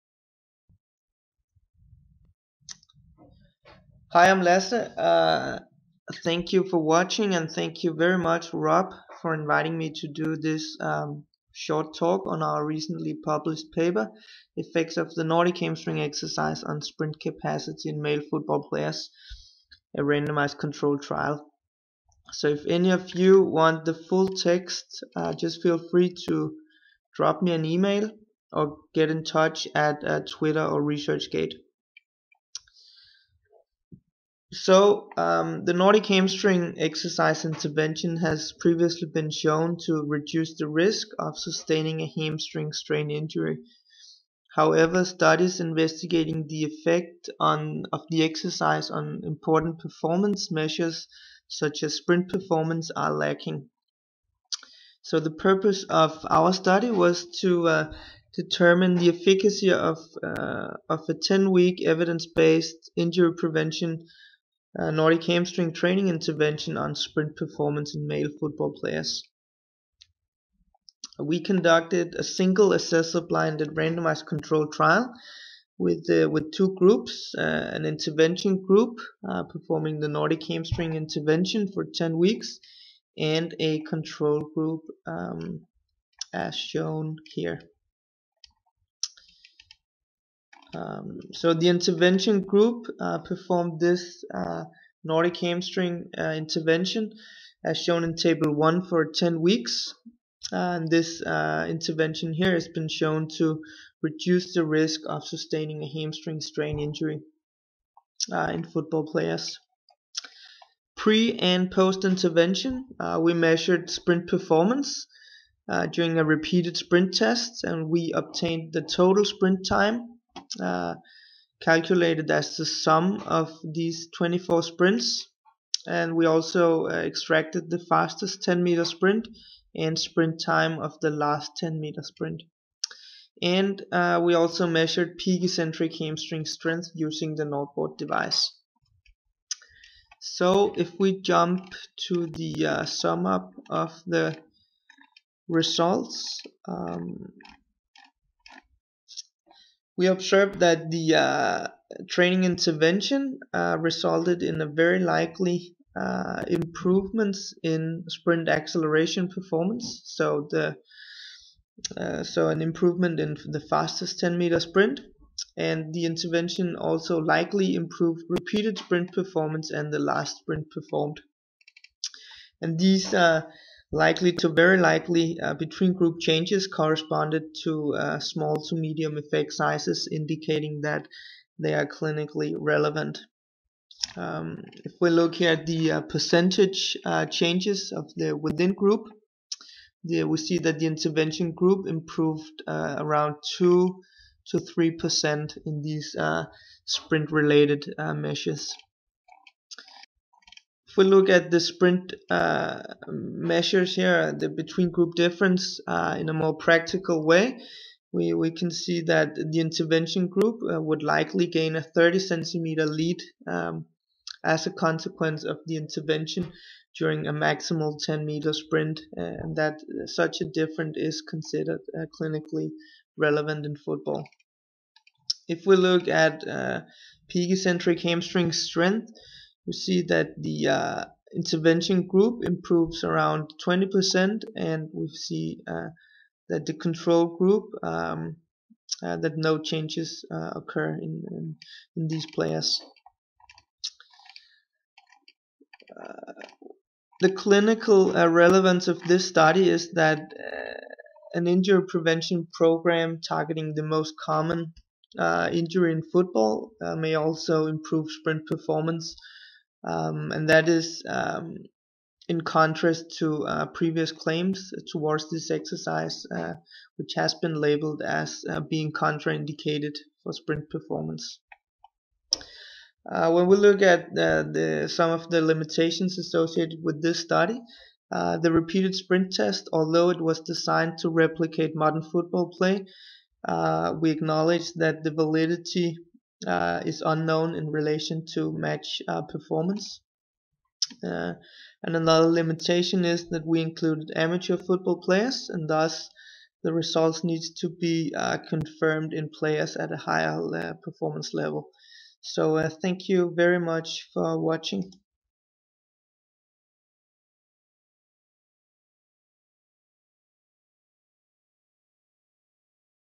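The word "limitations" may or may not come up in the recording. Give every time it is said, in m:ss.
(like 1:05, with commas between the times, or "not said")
4:35, 4:52.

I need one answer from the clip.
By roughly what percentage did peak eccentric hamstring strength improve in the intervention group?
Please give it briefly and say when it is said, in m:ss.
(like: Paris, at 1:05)
20%, at 3:53.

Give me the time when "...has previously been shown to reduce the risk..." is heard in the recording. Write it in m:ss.
0:38.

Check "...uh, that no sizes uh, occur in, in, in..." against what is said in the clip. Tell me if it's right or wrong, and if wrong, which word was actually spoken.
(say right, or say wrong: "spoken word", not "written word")
wrong: "changes", not "sizes".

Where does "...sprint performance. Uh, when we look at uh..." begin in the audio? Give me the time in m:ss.
4:30.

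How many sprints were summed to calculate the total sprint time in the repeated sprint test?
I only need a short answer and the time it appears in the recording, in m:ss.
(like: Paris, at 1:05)
24, at 2:04.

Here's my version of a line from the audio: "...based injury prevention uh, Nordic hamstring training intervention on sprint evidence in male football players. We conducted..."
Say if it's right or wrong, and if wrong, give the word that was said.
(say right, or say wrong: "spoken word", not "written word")
wrong: "performance", not "evidence".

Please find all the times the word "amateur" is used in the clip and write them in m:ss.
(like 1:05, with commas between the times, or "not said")
4:54.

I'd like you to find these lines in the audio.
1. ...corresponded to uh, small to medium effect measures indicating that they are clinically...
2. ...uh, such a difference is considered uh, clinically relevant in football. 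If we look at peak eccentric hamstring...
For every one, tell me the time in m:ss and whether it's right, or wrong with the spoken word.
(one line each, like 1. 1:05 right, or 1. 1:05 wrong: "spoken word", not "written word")
1. 2:56 wrong: "sizes", not "measures"
2. 3:39 right.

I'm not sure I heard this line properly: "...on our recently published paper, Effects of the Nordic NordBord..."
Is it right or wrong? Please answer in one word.
wrong.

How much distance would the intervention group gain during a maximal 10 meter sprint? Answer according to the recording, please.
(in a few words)
30 centimeters.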